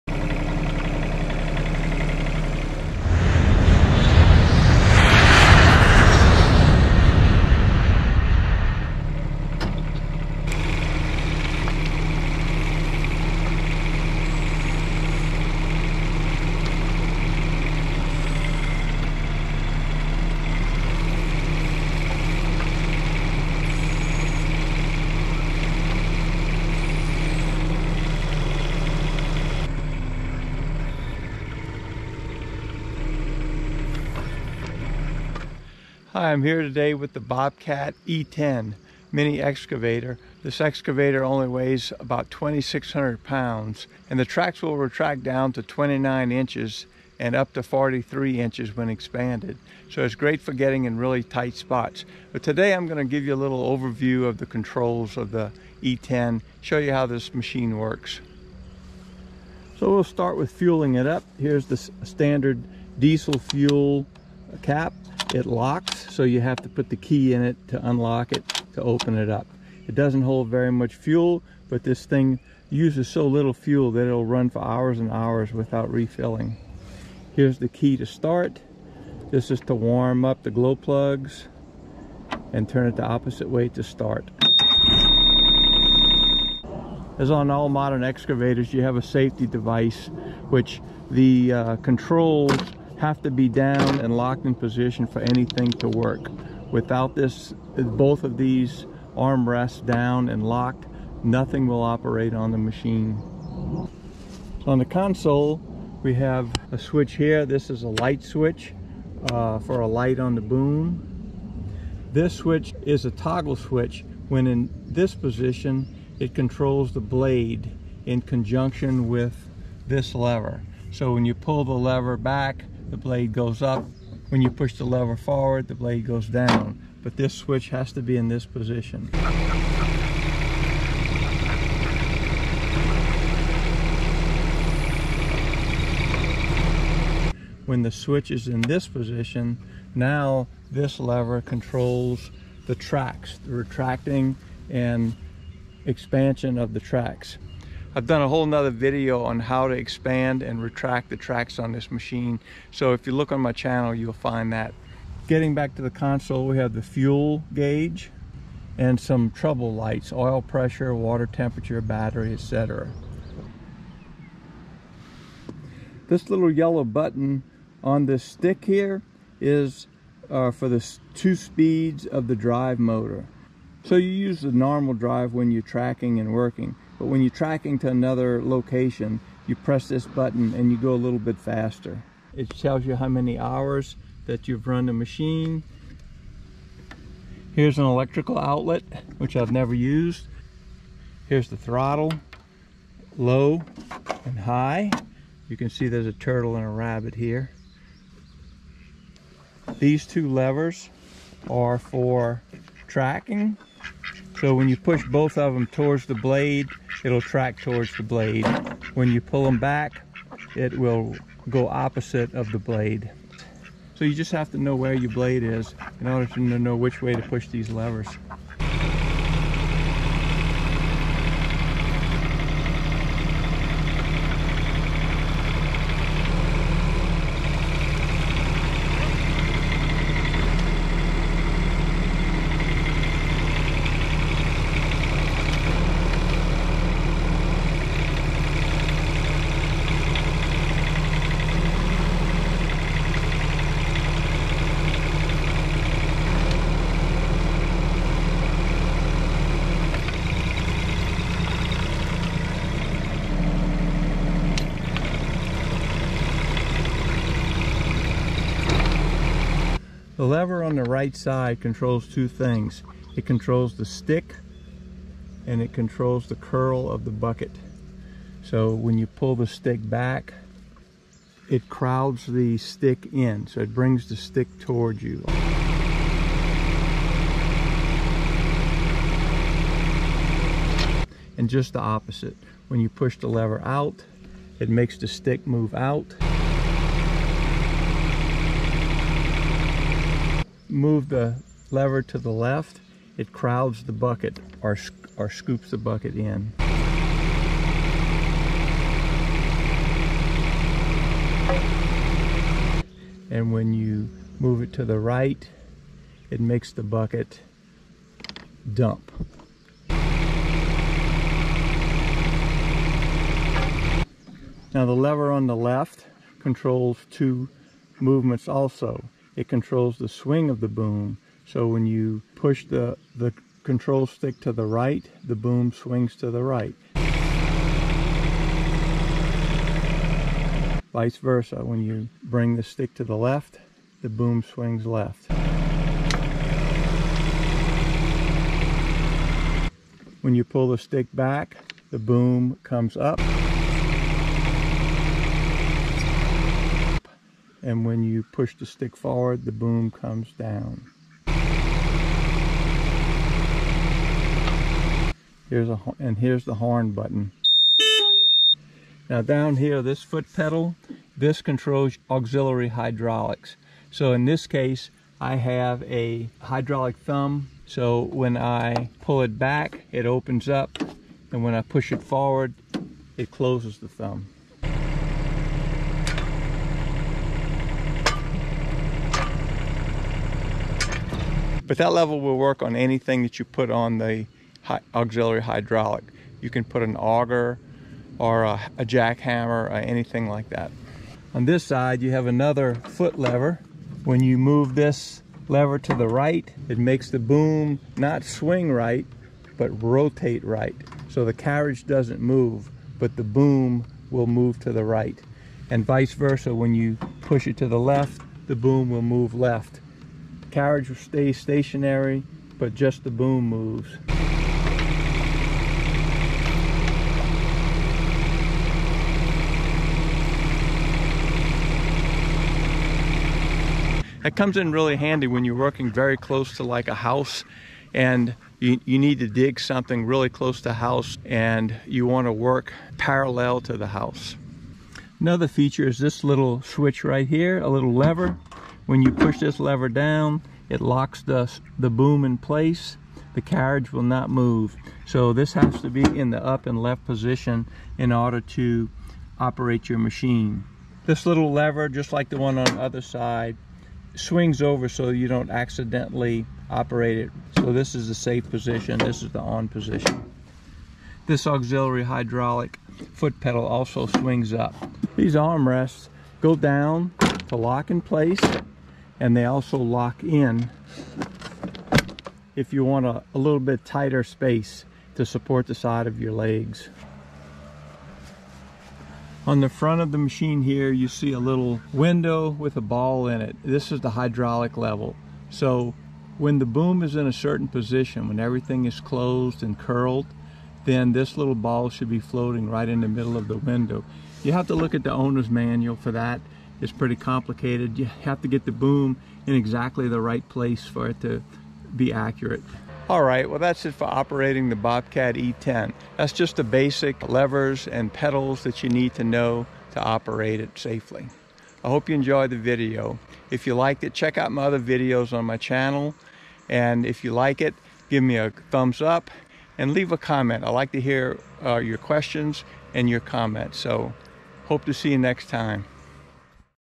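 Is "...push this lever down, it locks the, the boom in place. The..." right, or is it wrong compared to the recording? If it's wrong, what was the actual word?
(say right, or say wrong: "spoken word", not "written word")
right.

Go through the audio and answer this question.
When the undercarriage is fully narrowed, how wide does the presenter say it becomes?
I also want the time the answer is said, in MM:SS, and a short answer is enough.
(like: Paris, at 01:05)
29 inches, at 00:45.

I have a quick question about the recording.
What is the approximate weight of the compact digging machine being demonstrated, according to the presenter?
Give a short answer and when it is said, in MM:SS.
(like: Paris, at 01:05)
2,600 pounds, at 00:42.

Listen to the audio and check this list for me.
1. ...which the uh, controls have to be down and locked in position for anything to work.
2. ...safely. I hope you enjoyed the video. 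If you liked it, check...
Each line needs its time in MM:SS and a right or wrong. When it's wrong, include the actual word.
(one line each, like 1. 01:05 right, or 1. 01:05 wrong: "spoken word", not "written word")
1. 01:30 right
2. 08:30 right.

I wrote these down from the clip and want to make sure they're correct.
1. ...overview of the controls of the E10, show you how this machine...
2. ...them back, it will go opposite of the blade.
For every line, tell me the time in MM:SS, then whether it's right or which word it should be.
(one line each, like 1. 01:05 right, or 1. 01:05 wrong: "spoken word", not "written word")
1. 00:53 right
2. 03:29 right.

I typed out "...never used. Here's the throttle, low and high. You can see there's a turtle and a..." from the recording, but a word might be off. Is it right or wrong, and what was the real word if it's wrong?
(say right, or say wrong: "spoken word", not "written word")
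right.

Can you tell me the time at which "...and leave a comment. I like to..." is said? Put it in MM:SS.
08:39.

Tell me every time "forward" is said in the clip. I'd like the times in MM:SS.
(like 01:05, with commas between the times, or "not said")
02:05, 05:48, 06:12.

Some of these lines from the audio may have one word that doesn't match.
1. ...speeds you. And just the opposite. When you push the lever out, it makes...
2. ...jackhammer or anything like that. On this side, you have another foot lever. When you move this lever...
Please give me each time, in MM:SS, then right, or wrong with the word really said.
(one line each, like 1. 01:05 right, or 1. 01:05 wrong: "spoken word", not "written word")
1. 04:34 wrong: "towards", not "speeds"
2. 06:28 right.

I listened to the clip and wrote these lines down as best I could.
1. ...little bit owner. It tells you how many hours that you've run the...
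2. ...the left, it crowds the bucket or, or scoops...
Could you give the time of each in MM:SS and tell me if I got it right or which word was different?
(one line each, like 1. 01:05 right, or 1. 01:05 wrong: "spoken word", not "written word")
1. 03:01 wrong: "faster", not "owner"
2. 04:52 right.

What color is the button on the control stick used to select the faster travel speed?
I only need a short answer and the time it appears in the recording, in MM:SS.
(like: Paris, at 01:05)
yellow, at 02:46.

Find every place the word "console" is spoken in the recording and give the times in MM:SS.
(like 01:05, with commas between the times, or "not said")
01:44, 02:35.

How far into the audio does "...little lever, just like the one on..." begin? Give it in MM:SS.
07:31.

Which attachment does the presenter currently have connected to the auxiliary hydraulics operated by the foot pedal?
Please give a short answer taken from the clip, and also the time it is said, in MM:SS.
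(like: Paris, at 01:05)
hydraulic thumb, at 06:06.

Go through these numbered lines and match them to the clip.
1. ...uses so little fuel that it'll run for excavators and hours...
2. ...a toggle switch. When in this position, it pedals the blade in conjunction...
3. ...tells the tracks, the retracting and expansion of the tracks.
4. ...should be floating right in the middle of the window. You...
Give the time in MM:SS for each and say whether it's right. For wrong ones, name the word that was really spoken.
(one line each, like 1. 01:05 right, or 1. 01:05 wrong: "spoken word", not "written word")
1. 01:12 wrong: "hours", not "excavators"
2. 01:53 wrong: "controls", not "pedals"
3. 02:21 wrong: "controls", not "tells"
4. 08:11 right.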